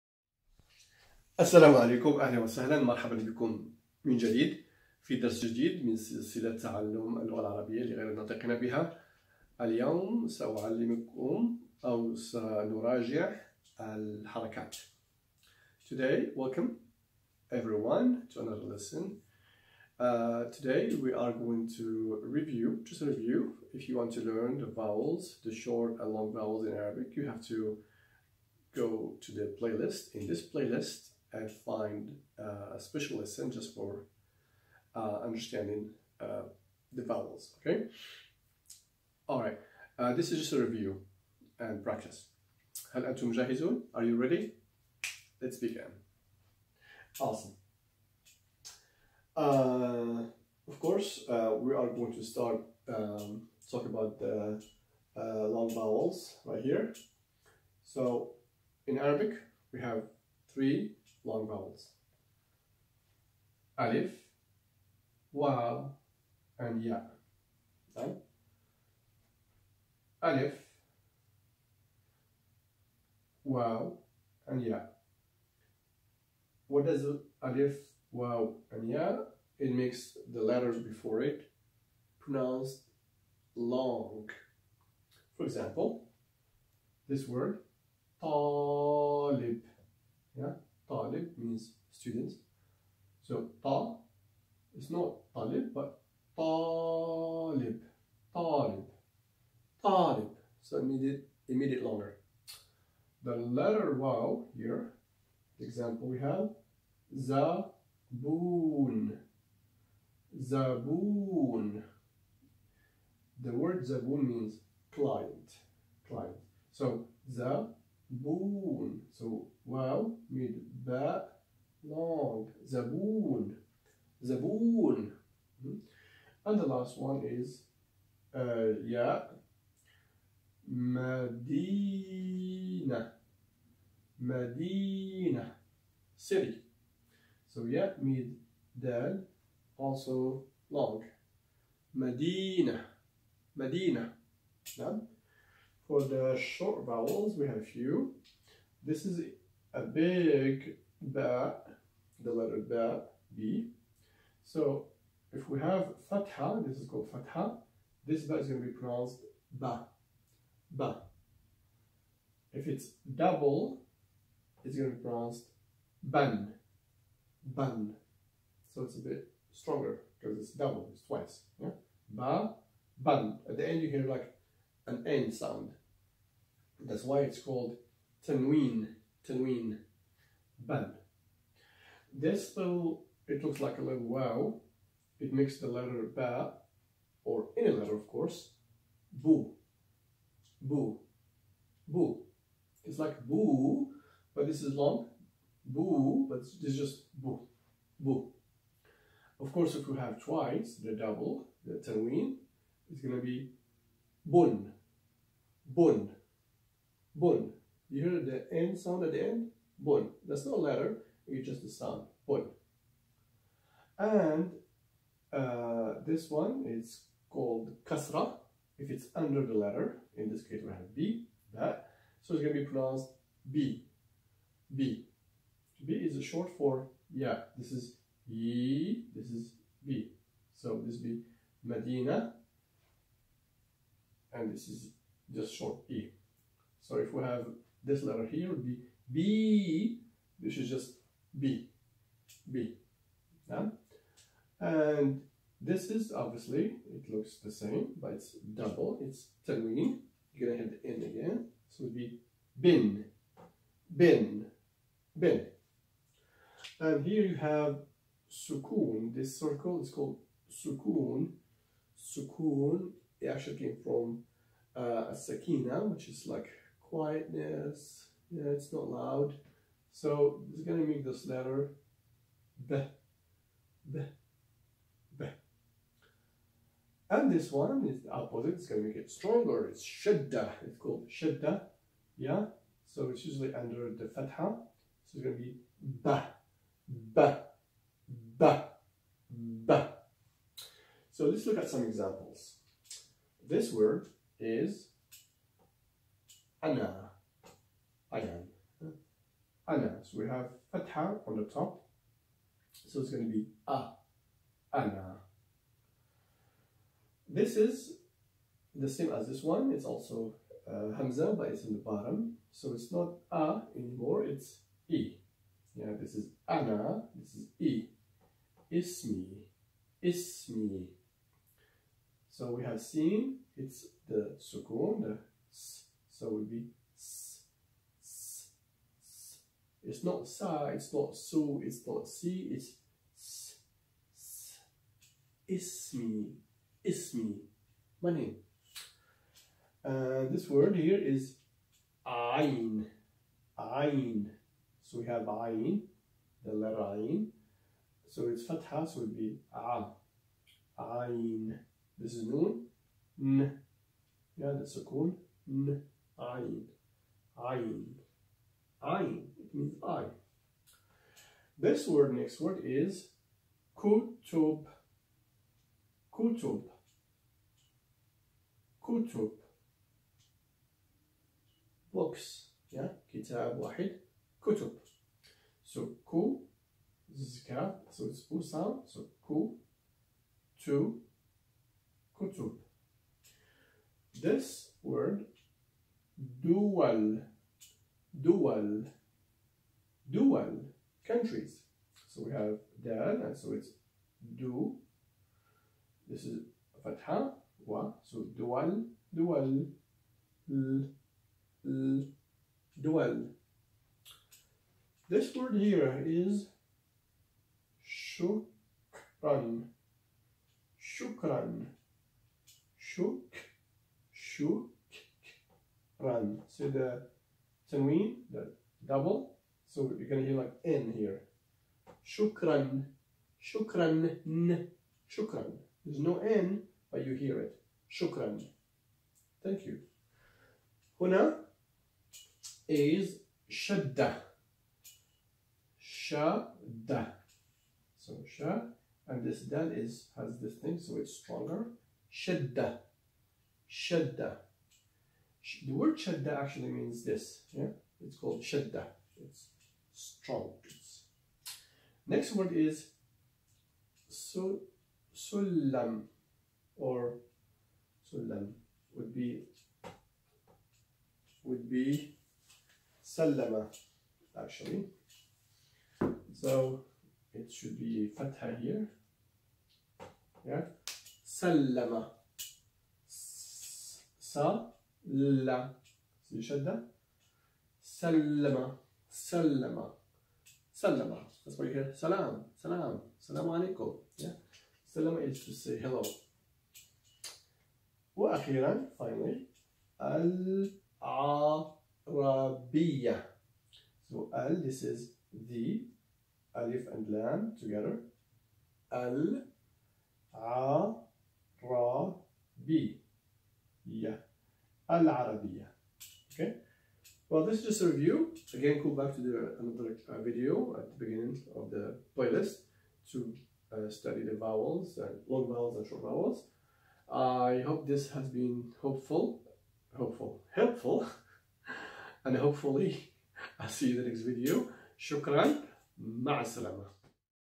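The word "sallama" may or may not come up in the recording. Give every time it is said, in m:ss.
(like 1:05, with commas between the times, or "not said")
7:43, 7:51.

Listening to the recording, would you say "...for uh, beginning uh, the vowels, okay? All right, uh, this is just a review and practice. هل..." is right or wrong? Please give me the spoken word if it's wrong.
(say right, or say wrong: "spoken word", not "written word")
wrong: "understanding", not "beginning".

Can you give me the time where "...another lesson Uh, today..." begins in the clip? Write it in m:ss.
0:18.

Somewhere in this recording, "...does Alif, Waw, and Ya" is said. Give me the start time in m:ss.
1:16.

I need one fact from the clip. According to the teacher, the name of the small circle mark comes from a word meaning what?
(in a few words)
quietness.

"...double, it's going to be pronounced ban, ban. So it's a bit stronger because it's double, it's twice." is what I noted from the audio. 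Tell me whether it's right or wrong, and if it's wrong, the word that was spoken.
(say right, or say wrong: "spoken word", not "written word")
right.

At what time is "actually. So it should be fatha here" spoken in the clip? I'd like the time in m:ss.
7:44.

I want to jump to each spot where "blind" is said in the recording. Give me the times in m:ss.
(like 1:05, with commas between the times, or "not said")
not said.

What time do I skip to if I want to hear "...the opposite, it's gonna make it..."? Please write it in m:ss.
4:38.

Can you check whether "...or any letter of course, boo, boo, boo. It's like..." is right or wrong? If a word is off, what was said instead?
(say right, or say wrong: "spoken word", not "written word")
right.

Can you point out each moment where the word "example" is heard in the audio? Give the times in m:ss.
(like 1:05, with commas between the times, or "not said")
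1:25, 1:45, 4:51.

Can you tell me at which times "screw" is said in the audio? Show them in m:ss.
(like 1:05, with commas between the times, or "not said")
not said.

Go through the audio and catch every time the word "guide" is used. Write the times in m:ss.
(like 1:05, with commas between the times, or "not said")
not said.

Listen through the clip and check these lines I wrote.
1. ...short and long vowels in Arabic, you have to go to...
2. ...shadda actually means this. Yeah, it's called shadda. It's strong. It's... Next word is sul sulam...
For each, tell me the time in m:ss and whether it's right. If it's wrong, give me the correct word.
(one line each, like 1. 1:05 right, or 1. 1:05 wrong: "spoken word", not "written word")
1. 0:25 right
2. 7:25 right.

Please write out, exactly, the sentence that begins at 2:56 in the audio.
That's why it's called tanween, tanween, ban.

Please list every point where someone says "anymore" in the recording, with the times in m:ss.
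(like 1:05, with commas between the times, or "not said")
5:13.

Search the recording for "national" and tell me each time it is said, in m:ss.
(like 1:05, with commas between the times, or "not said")
not said.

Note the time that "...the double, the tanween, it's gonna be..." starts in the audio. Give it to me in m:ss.
3:20.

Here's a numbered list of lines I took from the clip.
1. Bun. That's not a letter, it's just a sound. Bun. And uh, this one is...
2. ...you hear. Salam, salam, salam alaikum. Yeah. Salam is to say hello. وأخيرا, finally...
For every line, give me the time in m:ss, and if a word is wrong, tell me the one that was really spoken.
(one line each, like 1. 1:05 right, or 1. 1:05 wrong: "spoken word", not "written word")
1. 3:29 right
2. 8:01 right.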